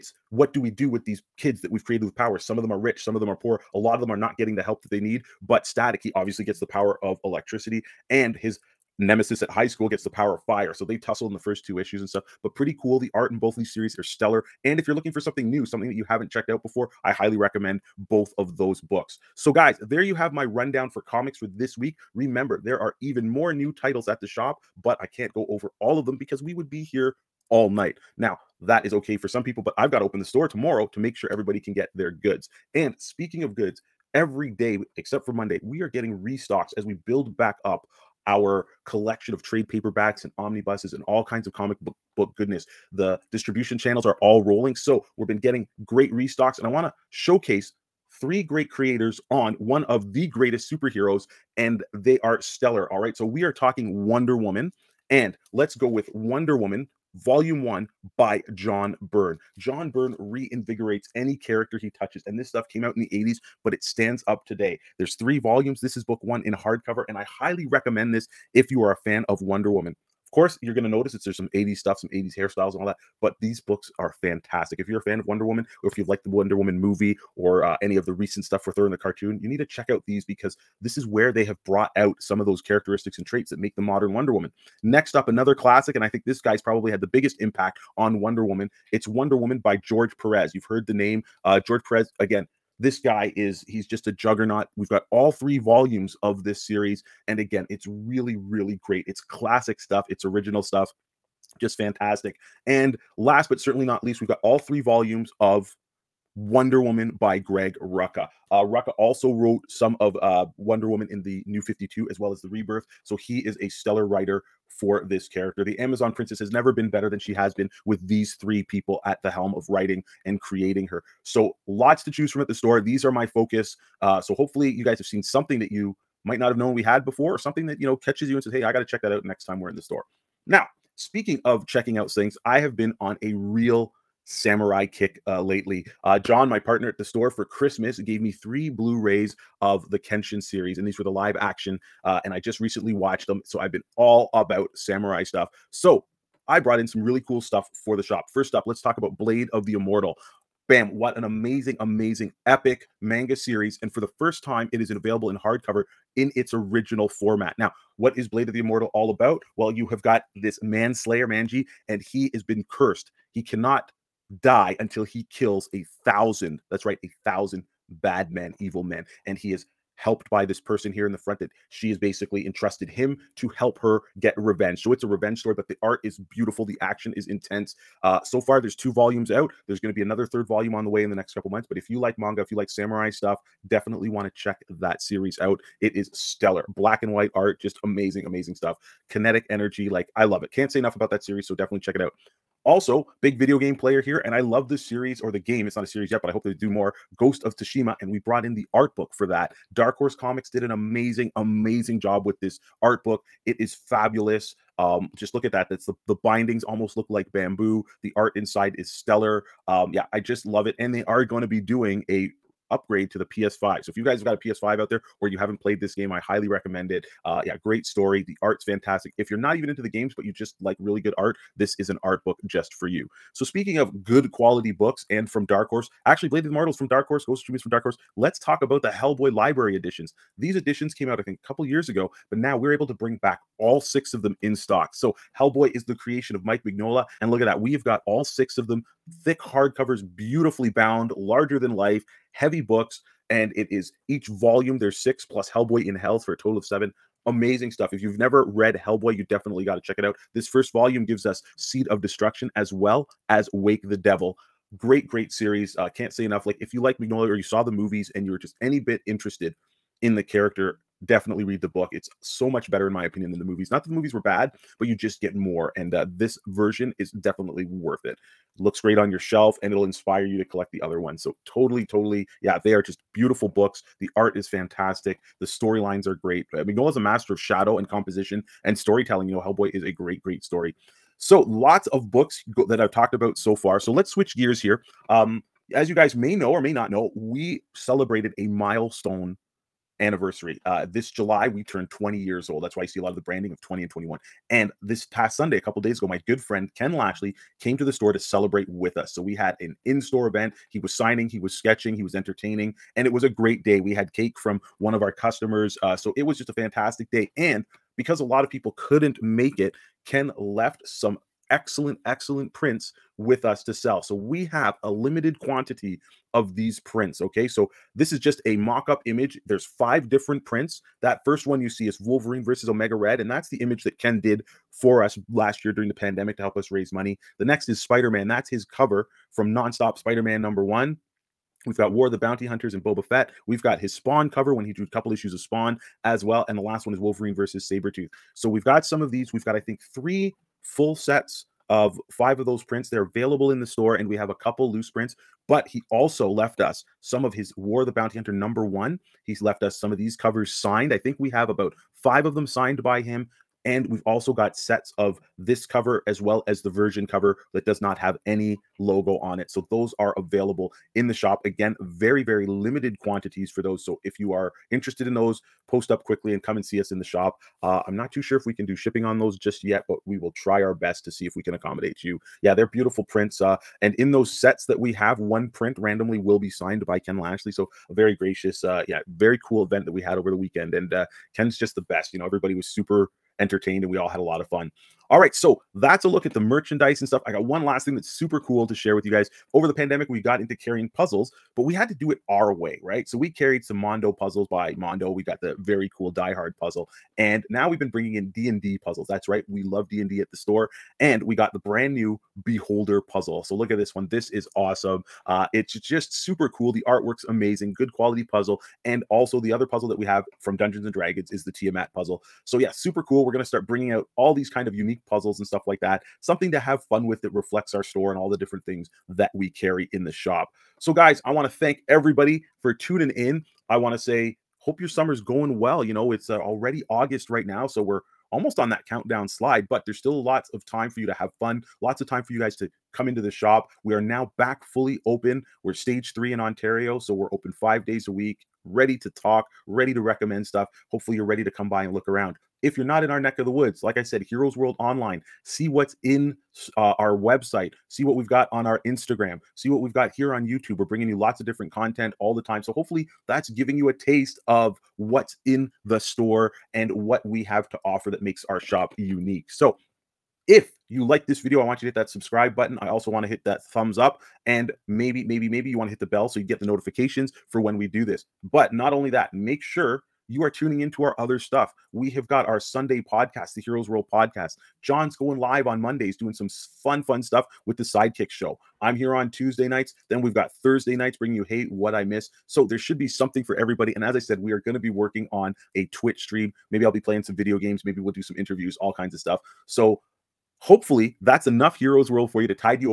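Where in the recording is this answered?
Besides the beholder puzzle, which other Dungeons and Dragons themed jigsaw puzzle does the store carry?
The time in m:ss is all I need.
6:51.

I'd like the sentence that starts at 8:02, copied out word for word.
So there should be something for everybody.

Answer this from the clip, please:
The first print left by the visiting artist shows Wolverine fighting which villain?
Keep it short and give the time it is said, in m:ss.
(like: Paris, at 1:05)
Omega Red, at 5:22.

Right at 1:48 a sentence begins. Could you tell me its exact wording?
Uh, Rucka also wrote some of uh, Wonder Woman in the New 52 as well as the Rebirth.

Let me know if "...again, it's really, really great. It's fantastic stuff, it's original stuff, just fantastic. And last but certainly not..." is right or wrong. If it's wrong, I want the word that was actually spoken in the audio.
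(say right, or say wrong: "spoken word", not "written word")
wrong: "classic", not "fantastic".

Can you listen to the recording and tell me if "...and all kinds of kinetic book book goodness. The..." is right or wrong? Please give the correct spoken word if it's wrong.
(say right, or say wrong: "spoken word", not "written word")
wrong: "comic", not "kinetic".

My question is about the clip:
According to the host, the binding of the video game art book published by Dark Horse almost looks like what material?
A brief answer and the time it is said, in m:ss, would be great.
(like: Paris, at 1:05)
bamboo, at 3:27.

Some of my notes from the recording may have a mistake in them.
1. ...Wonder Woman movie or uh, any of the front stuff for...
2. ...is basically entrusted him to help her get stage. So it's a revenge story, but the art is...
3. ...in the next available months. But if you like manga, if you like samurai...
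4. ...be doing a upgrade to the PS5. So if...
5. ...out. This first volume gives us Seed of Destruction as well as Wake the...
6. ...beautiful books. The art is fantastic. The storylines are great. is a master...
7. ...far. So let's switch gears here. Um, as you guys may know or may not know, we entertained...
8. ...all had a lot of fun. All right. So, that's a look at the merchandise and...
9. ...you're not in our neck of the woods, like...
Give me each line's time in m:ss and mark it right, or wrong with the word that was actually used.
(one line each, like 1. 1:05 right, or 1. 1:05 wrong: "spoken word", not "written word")
1. 1:16 wrong: "recent", not "front"
2. 2:51 wrong: "revenge", not "stage"
3. 3:01 wrong: "couple", not "available"
4. 3:31 right
5. 4:10 right
6. 4:33 right
7. 4:43 wrong: "celebrated", not "entertained"
8. 6:23 right
9. 7:22 right.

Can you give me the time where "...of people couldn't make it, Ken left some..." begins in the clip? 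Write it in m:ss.
5:08.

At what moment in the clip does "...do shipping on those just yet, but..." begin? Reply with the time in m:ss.
6:08.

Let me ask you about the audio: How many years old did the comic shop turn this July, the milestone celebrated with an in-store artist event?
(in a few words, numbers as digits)
20.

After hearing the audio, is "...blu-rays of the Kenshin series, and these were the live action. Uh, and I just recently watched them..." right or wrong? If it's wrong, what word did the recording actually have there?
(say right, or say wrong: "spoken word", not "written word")
right.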